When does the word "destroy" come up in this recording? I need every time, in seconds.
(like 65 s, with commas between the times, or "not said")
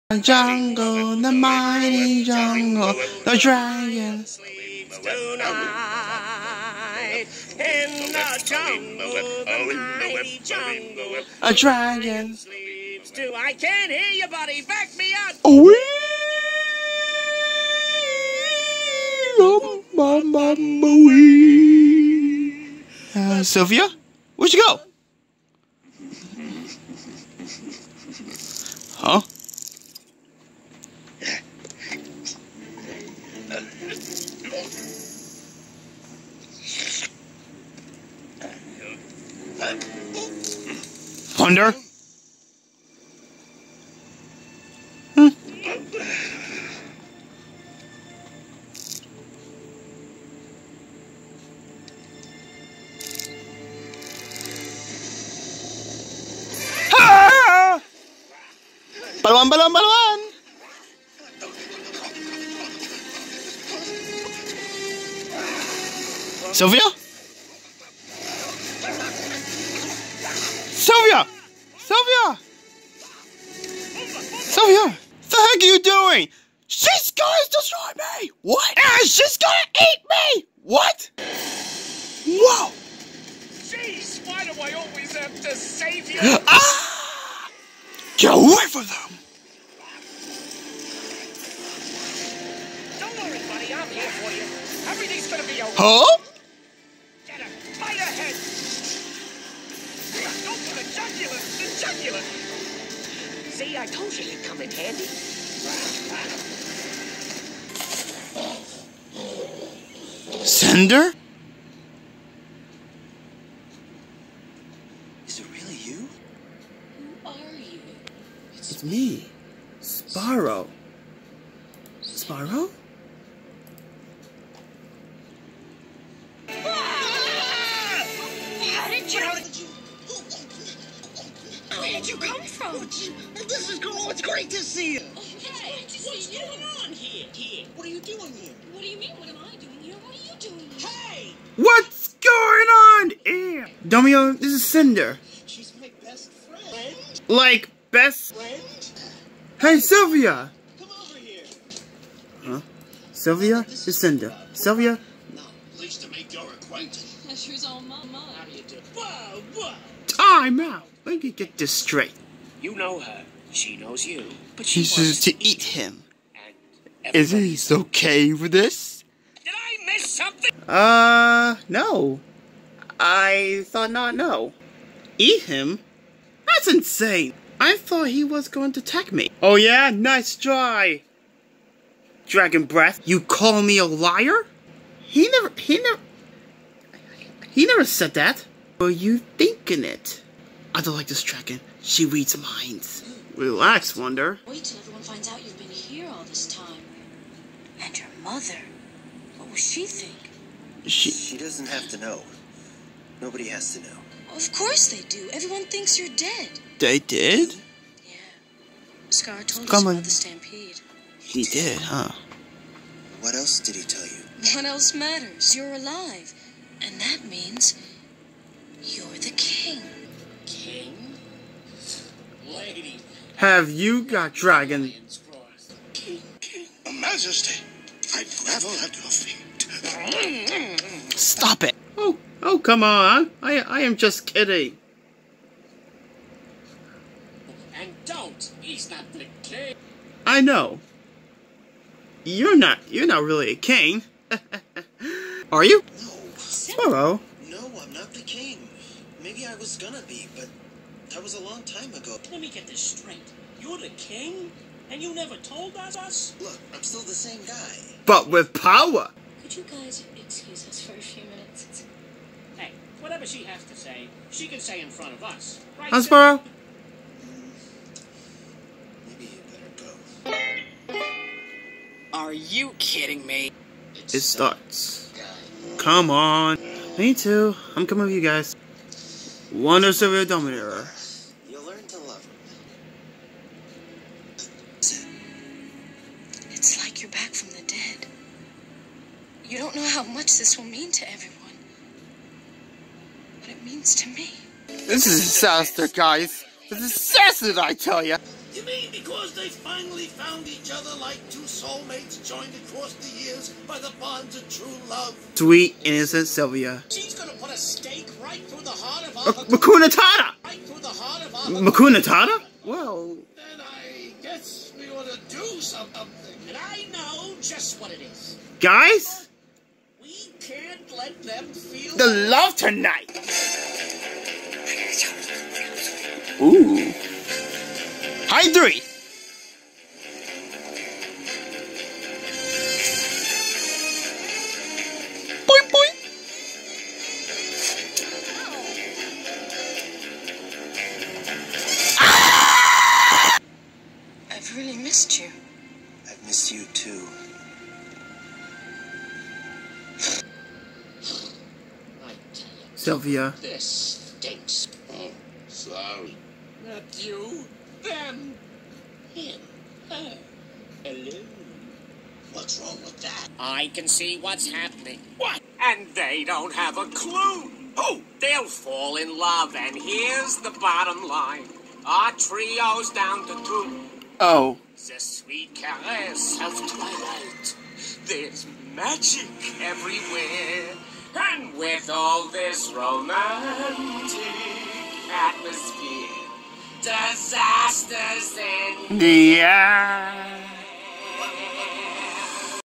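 77 s.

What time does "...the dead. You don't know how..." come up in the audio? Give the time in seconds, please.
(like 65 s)
287 s.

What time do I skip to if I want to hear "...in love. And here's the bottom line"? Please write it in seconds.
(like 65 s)
368 s.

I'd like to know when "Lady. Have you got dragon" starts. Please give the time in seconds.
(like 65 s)
222 s.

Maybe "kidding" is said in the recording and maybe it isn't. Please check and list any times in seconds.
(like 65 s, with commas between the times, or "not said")
234 s, 272 s.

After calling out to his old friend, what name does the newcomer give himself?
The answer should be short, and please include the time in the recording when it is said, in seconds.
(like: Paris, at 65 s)
Sparrow, at 119 s.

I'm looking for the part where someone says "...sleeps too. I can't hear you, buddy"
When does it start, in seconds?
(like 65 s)
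12 s.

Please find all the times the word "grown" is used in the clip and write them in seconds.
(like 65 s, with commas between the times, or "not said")
not said.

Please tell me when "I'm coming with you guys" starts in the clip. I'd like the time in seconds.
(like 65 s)
277 s.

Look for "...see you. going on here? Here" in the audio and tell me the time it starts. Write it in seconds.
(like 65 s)
136 s.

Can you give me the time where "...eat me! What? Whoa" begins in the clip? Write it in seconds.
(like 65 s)
79 s.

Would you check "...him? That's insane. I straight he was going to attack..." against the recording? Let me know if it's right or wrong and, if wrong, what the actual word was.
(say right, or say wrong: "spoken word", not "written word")
wrong: "thought", not "straight".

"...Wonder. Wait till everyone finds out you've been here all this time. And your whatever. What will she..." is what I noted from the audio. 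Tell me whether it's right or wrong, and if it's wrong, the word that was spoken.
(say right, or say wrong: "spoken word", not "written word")
wrong: "mother", not "whatever".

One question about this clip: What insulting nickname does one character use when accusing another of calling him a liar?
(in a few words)
Dragon Breath.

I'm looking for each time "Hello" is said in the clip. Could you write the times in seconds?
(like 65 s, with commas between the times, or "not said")
246 s, 360 s.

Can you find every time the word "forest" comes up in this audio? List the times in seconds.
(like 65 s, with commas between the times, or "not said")
not said.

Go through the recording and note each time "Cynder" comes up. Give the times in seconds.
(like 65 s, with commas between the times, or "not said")
110 s, 144 s, 153 s.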